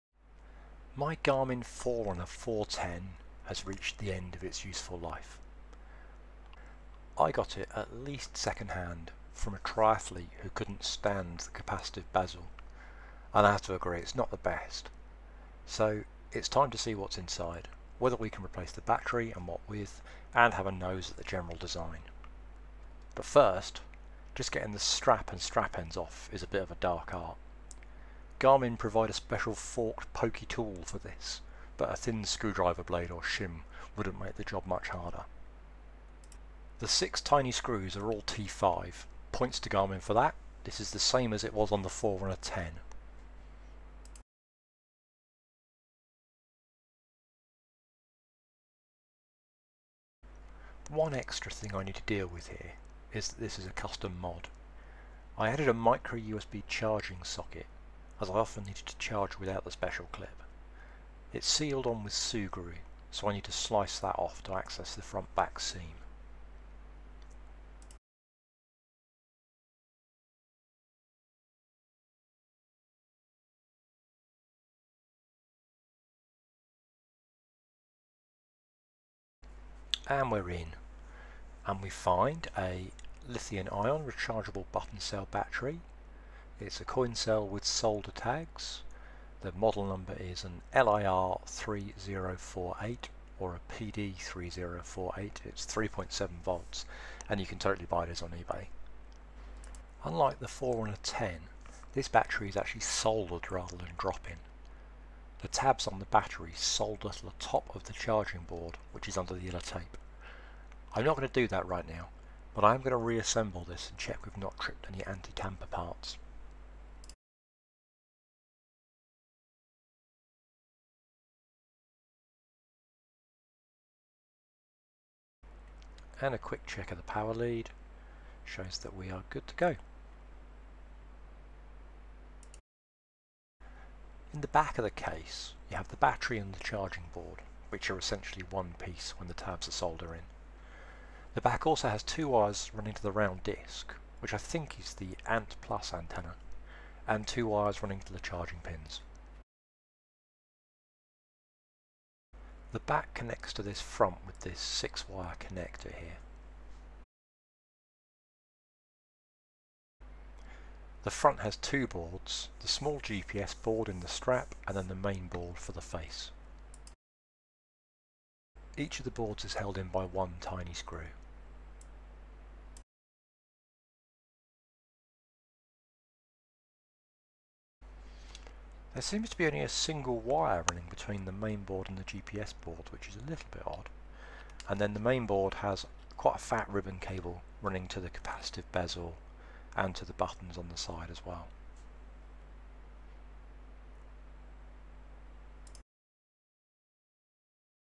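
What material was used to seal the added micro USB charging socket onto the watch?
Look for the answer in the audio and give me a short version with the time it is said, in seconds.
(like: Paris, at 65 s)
Sugru, at 62 s.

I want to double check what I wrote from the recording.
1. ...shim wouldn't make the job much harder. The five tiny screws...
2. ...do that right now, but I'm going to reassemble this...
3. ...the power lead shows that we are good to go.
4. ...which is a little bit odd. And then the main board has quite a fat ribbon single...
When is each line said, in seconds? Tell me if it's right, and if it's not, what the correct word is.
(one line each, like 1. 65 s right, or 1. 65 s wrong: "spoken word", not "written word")
1. 33 s wrong: "six", not "five"
2. 111 s right
3. 126 s right
4. 182 s wrong: "cable", not "single".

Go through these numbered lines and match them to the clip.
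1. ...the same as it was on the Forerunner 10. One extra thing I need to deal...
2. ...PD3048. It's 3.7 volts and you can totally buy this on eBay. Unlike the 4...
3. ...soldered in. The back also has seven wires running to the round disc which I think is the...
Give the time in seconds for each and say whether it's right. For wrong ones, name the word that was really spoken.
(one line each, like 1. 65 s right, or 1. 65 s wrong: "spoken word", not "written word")
1. 40 s right
2. 93 s right
3. 139 s wrong: "two", not "seven".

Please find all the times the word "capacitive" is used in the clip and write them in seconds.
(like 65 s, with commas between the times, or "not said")
11 s, 188 s.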